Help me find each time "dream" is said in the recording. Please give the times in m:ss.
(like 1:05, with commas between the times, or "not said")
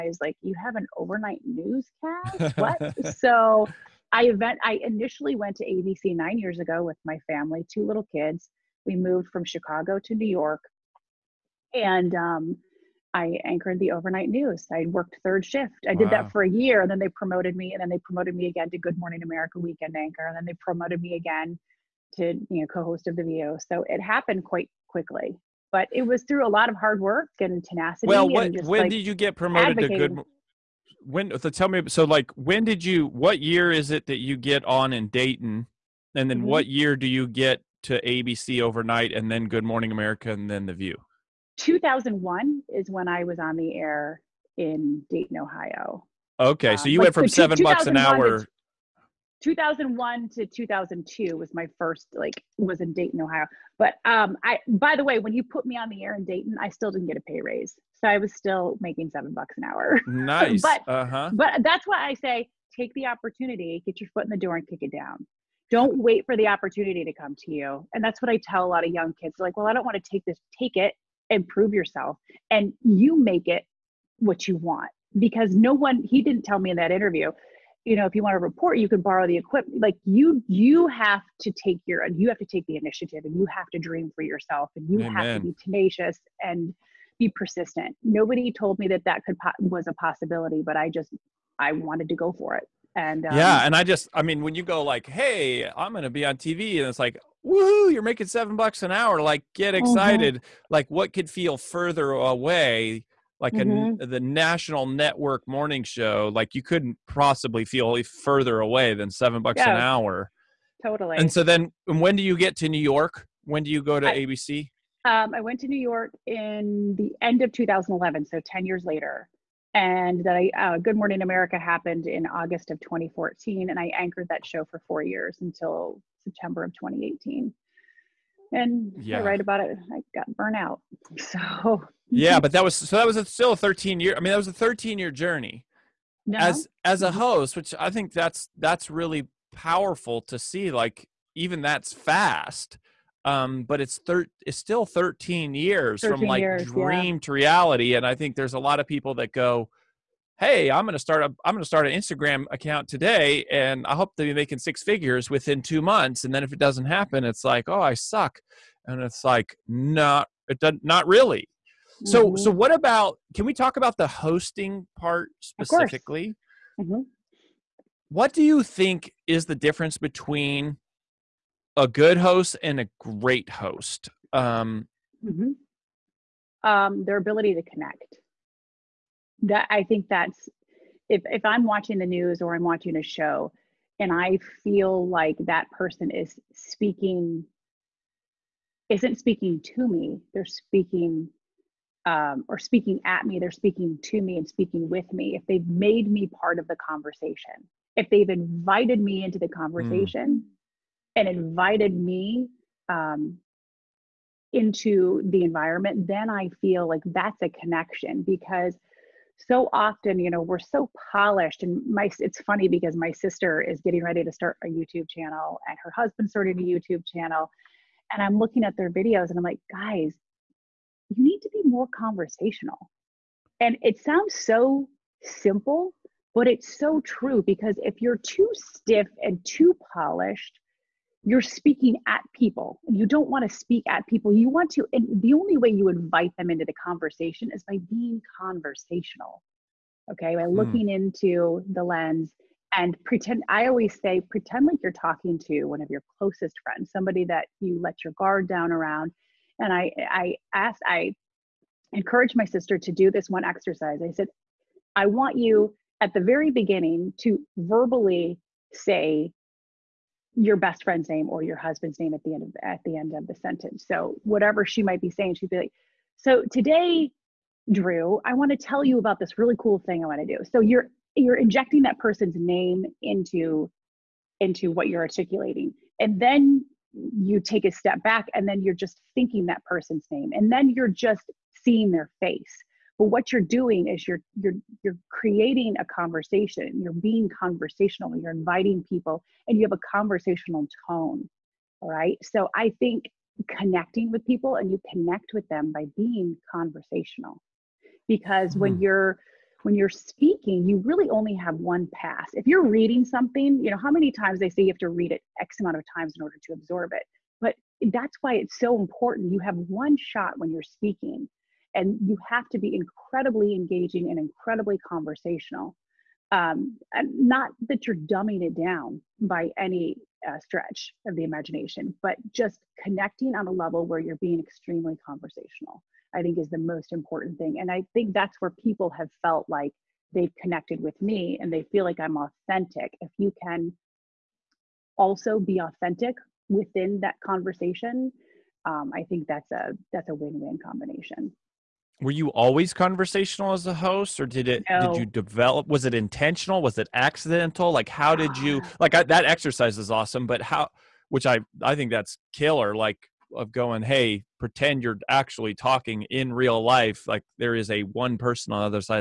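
1:23, 2:26.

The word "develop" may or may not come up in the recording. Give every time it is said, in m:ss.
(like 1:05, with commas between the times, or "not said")
5:45.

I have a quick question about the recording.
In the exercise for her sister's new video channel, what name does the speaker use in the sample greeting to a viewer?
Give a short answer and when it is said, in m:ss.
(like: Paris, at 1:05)
Drew, at 4:27.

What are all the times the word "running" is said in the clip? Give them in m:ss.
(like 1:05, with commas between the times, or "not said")
not said.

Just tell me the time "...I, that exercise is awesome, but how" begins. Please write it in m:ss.
5:48.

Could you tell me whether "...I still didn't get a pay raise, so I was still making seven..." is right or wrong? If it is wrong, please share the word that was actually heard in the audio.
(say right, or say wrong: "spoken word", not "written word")
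right.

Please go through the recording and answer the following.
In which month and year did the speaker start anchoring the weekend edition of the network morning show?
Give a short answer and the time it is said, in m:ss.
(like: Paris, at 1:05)
August 2014, at 2:02.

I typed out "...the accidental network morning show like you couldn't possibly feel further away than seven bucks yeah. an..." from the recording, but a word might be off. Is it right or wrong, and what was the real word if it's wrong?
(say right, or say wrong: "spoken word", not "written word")
wrong: "national", not "accidental".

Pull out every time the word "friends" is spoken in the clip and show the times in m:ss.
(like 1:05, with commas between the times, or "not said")
4:06, 4:20.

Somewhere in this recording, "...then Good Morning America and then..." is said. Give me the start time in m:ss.
0:39.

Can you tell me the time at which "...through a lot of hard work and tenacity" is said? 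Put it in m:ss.
0:26.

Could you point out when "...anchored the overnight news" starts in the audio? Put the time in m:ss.
0:13.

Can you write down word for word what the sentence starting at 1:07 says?
And that's what I tell a lot of young kids.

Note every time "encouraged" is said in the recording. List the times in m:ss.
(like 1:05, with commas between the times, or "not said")
4:11.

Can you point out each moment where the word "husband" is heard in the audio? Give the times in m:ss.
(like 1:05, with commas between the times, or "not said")
3:35, 4:21.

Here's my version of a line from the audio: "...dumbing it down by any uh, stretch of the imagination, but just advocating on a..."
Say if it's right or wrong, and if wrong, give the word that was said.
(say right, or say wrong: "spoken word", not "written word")
wrong: "connecting", not "advocating".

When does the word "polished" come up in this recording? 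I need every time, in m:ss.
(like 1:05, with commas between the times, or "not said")
3:31, 3:49.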